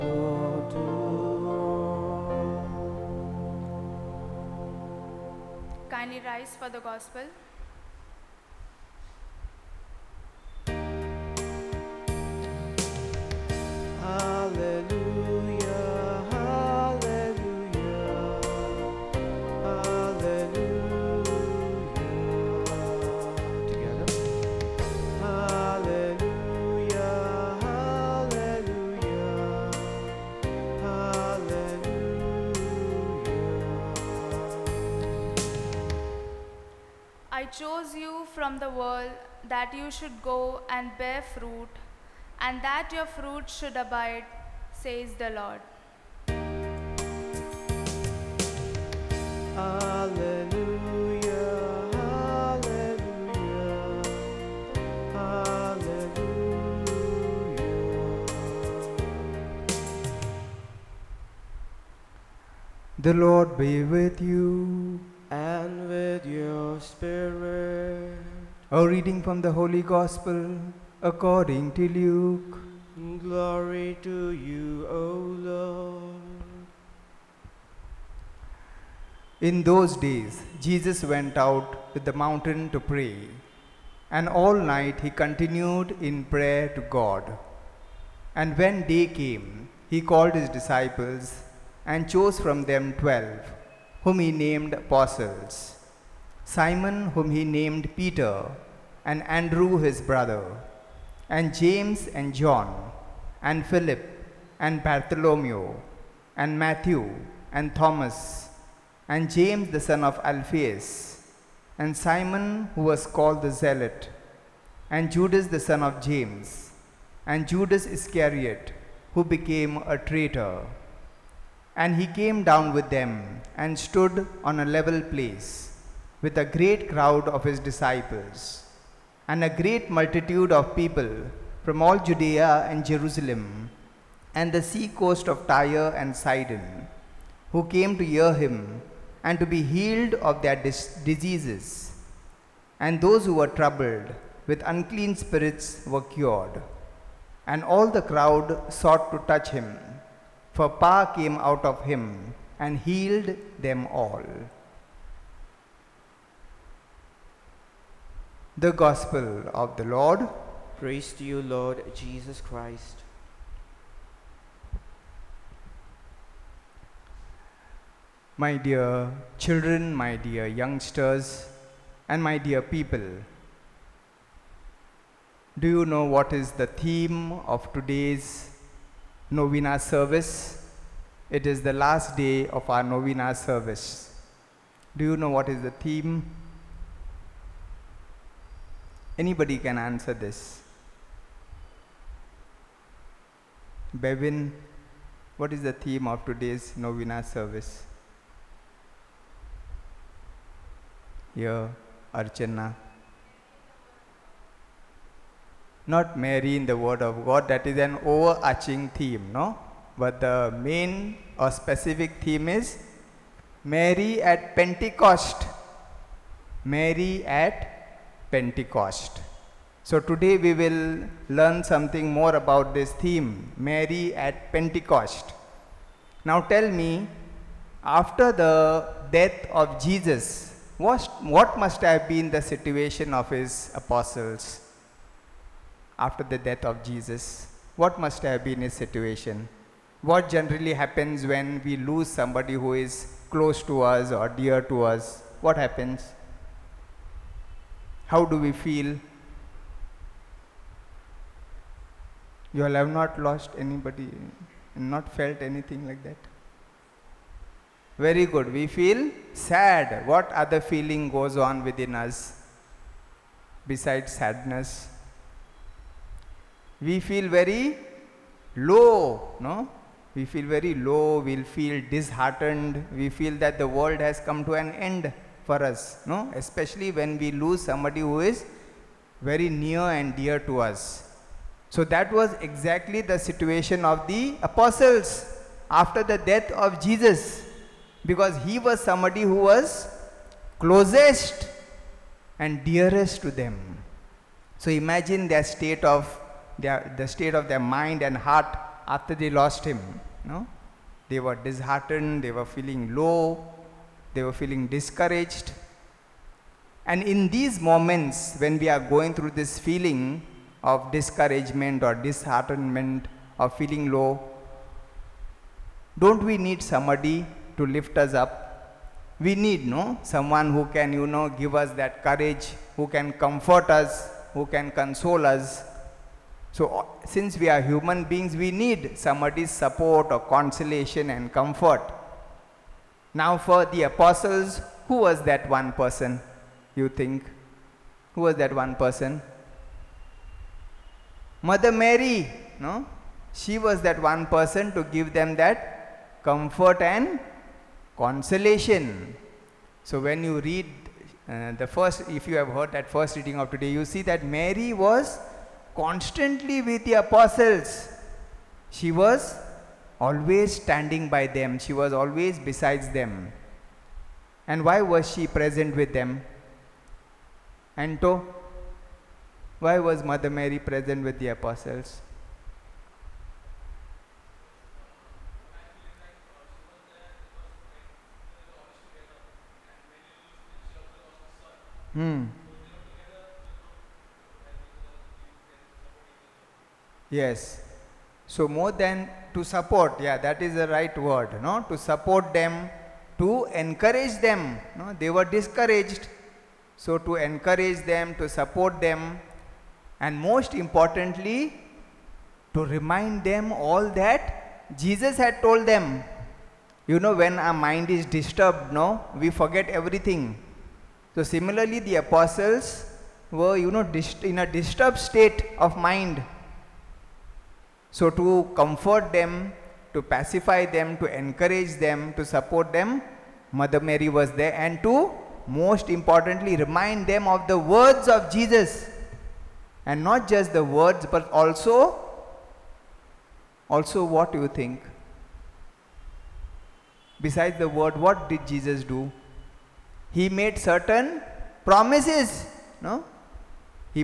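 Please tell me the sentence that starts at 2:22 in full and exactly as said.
And those who were troubled with unclean spirits were cured.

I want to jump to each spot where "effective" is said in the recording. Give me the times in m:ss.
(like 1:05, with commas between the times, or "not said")
not said.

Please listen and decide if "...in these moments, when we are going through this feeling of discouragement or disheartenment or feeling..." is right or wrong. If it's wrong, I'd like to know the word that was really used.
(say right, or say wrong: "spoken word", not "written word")
right.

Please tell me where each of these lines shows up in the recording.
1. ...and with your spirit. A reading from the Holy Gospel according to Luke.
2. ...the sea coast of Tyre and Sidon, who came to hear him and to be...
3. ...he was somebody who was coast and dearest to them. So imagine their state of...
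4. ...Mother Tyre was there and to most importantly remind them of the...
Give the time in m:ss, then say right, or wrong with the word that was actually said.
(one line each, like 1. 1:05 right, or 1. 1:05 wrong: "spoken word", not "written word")
1. 1:05 right
2. 2:14 right
3. 4:48 wrong: "closest", not "coast"
4. 7:03 wrong: "Mary", not "Tyre".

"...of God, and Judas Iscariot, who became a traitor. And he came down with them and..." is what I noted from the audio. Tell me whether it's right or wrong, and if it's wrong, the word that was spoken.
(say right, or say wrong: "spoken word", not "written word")
wrong: "James", not "God".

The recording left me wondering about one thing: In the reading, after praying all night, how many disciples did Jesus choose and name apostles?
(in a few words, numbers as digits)
12.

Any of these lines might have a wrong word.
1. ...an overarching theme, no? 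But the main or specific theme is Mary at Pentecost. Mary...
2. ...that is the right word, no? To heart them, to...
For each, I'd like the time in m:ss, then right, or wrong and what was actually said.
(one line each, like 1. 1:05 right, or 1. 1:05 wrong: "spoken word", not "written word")
1. 3:27 right
2. 6:30 wrong: "support", not "heart".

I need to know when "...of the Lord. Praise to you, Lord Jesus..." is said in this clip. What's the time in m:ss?
2:39.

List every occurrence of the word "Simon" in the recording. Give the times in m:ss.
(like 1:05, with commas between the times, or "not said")
1:36, 1:51.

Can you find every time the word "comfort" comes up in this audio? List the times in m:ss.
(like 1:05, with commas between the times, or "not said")
5:23, 5:31, 5:46, 6:58.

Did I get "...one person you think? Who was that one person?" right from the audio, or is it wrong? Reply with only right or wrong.
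right.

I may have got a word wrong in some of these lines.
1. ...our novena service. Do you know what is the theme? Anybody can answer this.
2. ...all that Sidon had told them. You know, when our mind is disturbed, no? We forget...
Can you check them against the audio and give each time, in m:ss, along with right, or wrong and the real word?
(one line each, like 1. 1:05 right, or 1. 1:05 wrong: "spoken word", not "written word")
1. 3:02 right
2. 6:43 wrong: "Jesus", not "Sidon".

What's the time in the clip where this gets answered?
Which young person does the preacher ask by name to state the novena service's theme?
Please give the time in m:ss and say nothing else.
3:13.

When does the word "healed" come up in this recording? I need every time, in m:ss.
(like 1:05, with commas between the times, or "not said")
2:19, 2:32.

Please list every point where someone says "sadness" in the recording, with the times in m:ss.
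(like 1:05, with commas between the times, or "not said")
4:24.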